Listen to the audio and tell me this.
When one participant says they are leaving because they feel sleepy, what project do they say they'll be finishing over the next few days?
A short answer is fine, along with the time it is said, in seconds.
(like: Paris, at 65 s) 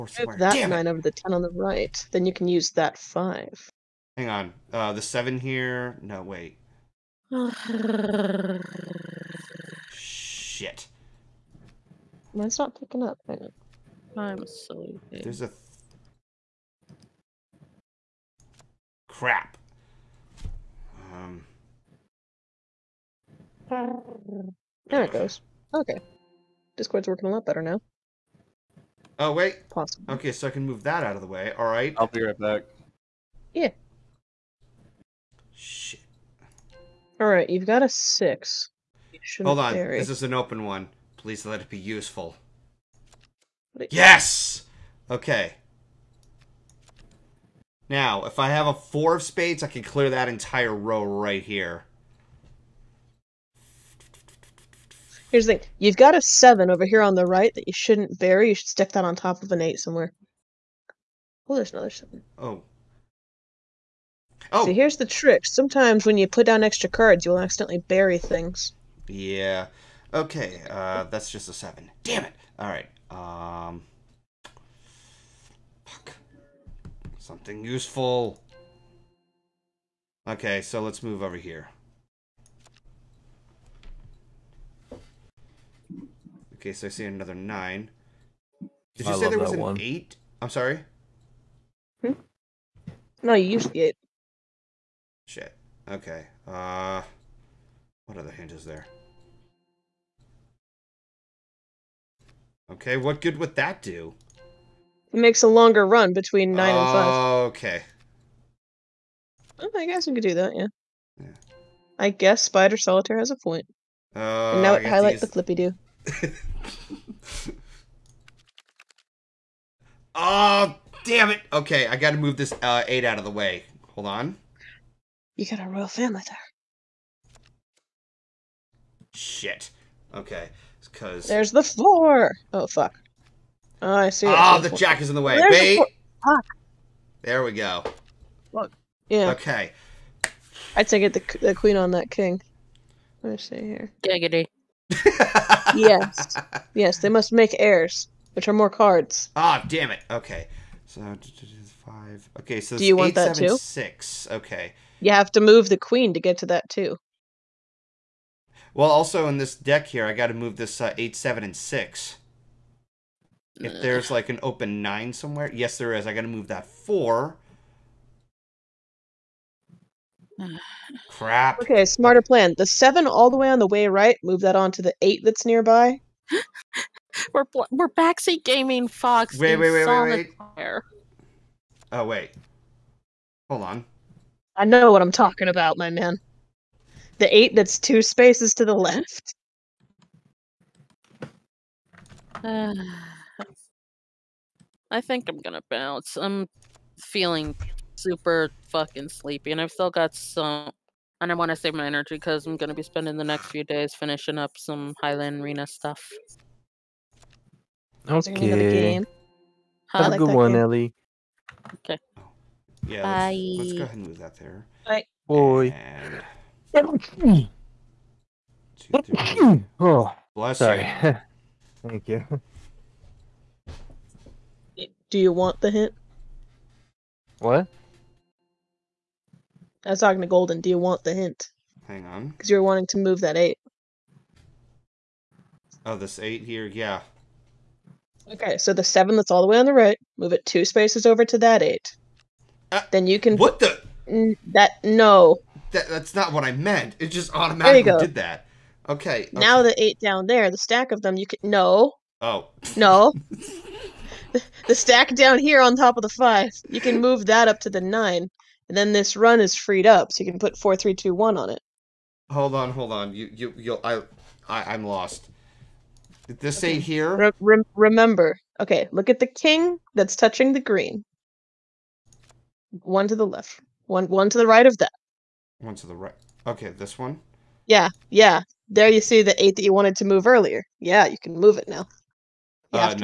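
Highland Arena, at 205 s.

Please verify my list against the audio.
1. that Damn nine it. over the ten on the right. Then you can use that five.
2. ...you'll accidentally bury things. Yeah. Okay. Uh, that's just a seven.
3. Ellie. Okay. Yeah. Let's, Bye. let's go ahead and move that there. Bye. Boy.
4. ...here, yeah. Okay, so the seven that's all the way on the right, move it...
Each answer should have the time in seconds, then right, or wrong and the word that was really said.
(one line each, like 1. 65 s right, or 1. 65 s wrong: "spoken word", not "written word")
1. 0 s right
2. 67 s right
3. 210 s right
4. 236 s right.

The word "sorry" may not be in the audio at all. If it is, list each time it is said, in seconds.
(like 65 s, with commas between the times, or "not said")
90 s, 220 s.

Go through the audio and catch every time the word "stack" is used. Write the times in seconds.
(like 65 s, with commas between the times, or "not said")
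250 s, 254 s.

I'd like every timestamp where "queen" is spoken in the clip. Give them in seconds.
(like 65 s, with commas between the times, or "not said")
141 s, 155 s.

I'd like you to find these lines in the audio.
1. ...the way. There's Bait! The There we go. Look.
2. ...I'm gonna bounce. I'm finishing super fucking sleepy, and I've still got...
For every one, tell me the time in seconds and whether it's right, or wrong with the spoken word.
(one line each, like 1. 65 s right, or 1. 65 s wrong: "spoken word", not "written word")
1. 135 s right
2. 195 s wrong: "feeling", not "finishing".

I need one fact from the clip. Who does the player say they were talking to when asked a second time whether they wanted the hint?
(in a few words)
Golden.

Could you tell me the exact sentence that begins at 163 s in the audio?
If there's like an open nine somewhere, yes, there is.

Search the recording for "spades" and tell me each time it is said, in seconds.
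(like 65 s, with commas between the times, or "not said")
49 s.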